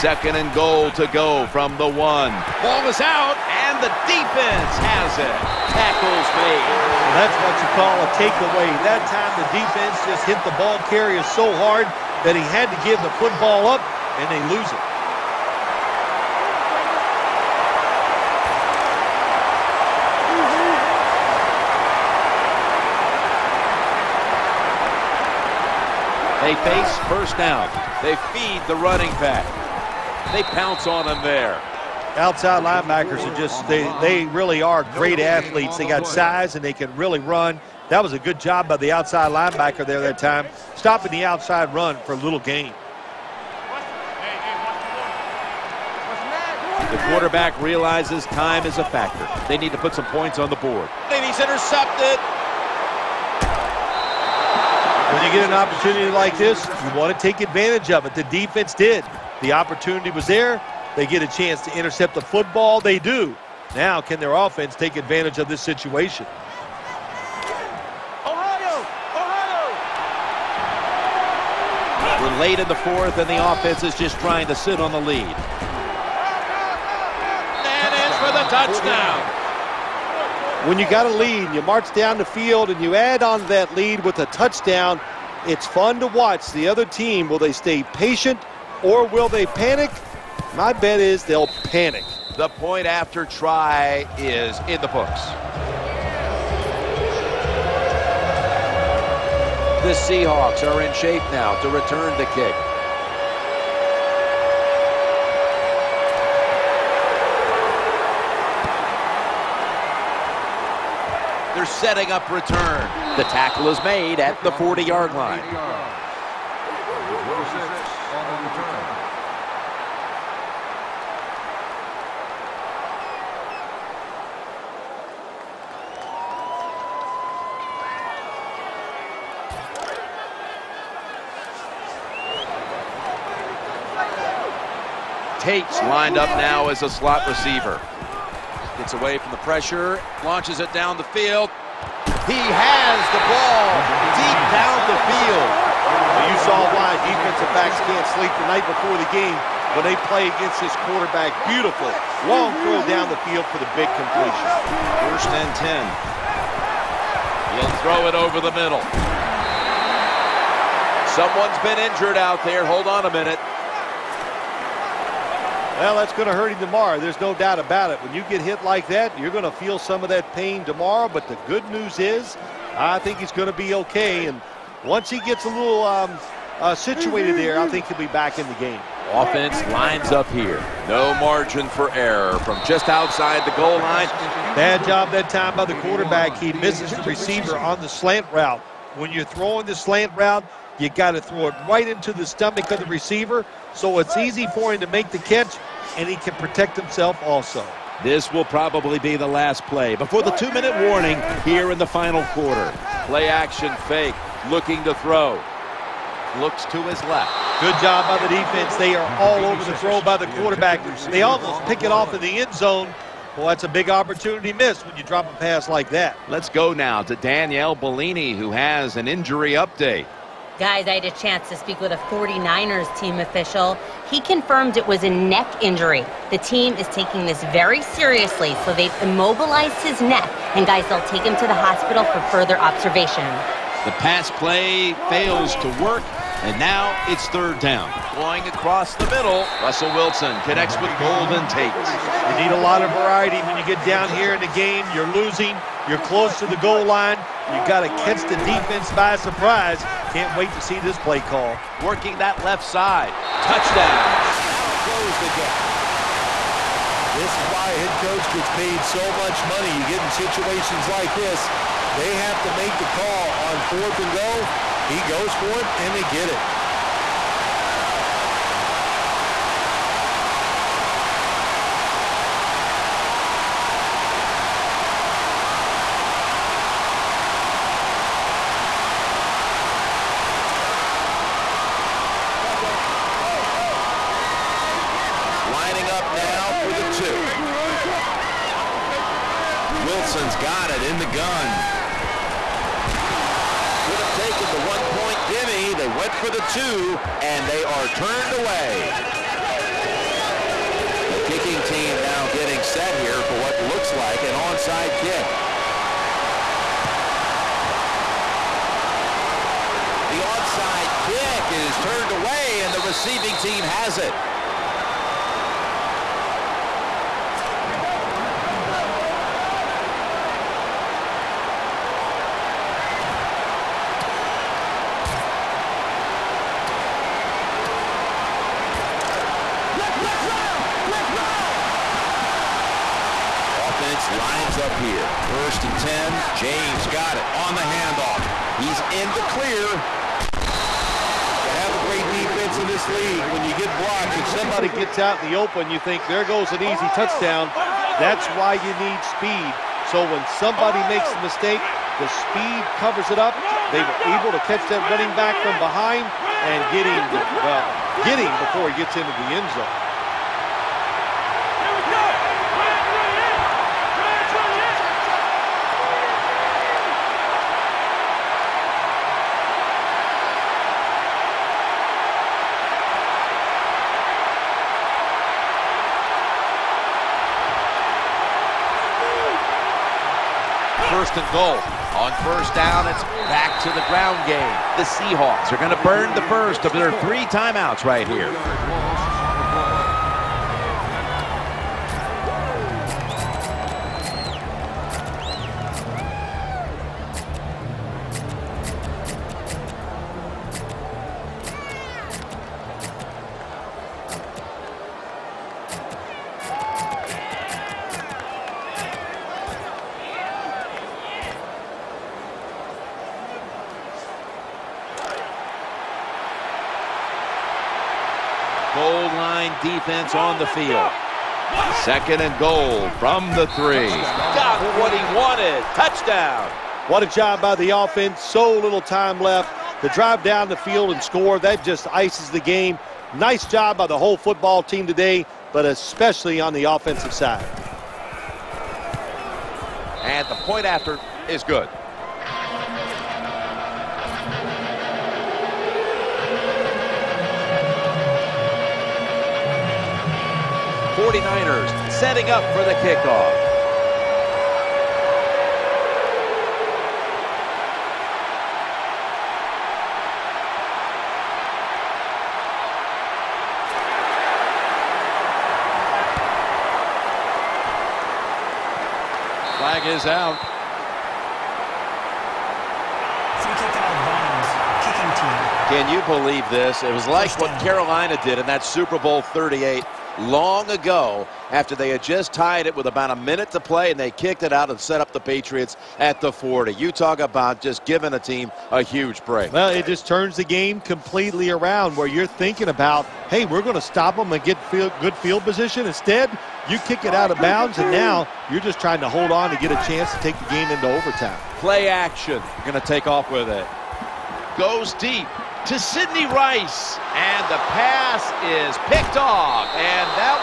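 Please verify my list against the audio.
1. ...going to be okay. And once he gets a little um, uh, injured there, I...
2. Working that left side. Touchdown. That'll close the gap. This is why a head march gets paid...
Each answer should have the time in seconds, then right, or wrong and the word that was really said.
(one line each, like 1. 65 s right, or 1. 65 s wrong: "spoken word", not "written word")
1. 173 s wrong: "situated", not "injured"
2. 251 s wrong: "coach", not "march".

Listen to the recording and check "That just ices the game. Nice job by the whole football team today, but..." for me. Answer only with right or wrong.
right.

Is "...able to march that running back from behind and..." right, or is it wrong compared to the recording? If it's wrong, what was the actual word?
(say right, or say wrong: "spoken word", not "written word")
wrong: "catch", not "march".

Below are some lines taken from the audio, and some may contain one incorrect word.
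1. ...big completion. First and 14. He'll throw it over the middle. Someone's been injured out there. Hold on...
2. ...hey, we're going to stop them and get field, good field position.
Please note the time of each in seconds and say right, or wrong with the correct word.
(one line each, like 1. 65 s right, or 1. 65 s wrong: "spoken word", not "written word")
1. 153 s wrong: "10", not "14"
2. 493 s right.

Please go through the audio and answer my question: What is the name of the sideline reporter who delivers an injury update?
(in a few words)
Danielle Bellini.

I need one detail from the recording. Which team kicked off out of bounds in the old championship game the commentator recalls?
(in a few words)
Carolina.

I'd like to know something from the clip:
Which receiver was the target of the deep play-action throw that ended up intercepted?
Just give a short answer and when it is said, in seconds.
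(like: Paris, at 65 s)
Sidney Rice, at 505 s.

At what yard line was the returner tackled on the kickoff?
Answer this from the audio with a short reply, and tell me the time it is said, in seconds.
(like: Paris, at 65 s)
40-yard line, at 114 s.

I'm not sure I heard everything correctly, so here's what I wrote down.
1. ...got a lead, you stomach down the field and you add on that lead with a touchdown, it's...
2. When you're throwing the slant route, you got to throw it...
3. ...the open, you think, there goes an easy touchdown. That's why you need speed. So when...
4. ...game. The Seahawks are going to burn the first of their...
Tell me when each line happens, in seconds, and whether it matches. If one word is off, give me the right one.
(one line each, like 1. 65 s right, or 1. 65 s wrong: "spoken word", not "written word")
1. 80 s wrong: "march", not "stomach"
2. 188 s right
3. 345 s right
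4. 384 s right.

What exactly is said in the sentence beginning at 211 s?
They almost pick it off in the end zone.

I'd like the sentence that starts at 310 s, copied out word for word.
The onside kick is turned away, and the receiving team has it.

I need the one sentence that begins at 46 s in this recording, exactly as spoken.
The quarterback realizes time is a factor.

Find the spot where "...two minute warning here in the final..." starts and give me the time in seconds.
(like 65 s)
200 s.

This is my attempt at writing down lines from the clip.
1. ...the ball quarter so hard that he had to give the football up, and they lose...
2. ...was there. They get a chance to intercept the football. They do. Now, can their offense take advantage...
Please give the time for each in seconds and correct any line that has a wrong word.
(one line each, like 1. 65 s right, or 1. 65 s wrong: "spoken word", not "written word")
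1. 10 s wrong: "carrier", not "quarter"
2. 60 s right.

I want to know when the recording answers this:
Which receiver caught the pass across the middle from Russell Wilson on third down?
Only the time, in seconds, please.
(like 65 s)
241 s.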